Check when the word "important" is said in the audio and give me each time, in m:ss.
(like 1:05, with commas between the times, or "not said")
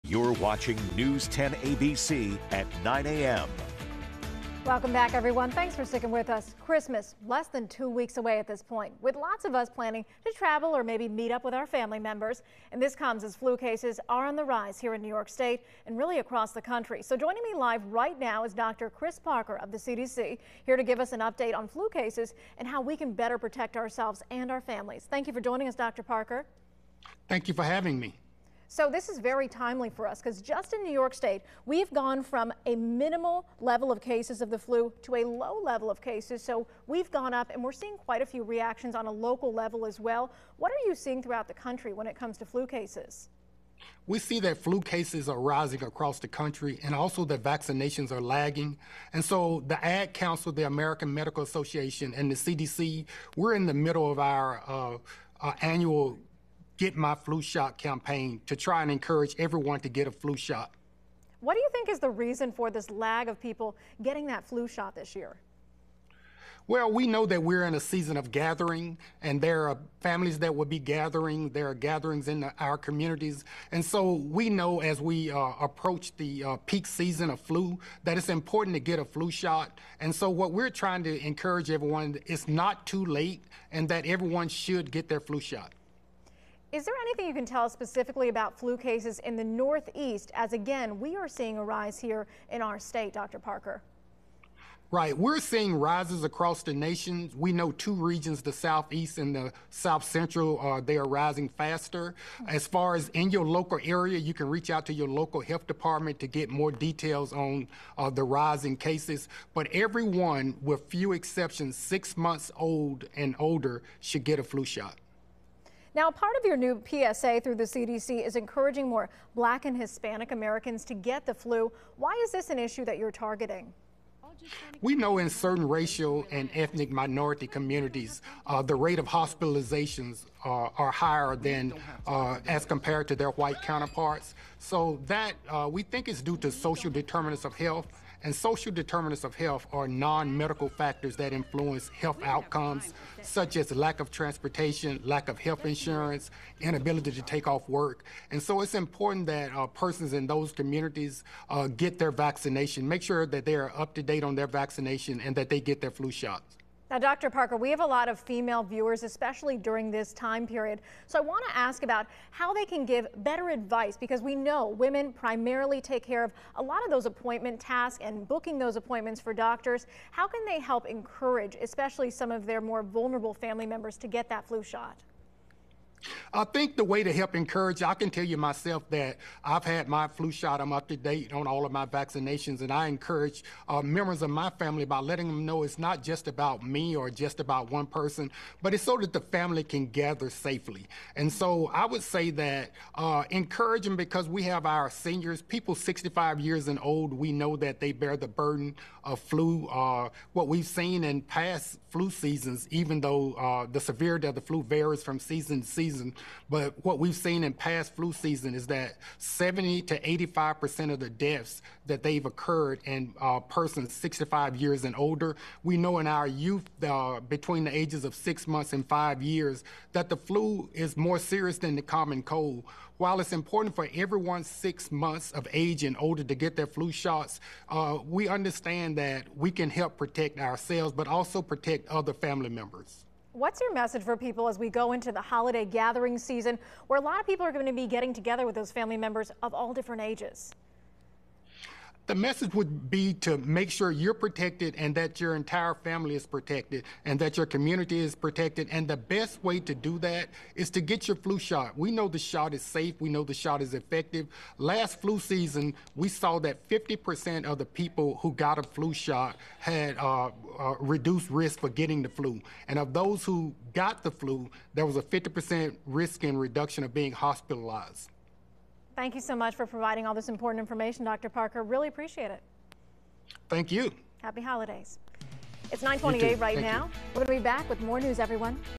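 1:18, 2:28, 3:43, 4:30.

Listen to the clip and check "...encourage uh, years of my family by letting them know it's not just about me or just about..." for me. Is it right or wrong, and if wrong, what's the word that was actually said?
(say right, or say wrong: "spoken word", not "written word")
wrong: "members", not "years".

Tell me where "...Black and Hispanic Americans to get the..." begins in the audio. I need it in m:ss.
1:59.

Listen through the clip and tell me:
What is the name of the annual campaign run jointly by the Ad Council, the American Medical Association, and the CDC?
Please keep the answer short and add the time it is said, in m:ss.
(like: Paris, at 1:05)
Get My Flu Shot, at 0:56.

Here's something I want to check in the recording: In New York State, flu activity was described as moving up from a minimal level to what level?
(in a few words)
low.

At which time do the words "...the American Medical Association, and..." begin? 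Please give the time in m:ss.
0:50.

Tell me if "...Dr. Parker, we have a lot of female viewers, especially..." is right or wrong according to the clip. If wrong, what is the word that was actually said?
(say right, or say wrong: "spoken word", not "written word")
right.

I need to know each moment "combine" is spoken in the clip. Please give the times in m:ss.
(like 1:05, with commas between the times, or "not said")
not said.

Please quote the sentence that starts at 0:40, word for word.
What are you seeing throughout the country when it comes to flu cases?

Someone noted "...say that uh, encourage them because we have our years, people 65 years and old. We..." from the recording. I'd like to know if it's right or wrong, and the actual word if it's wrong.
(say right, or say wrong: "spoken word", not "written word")
wrong: "seniors", not "years".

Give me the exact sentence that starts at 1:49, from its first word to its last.
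But everyone, with few exceptions, six months old and older, should get a flu shot.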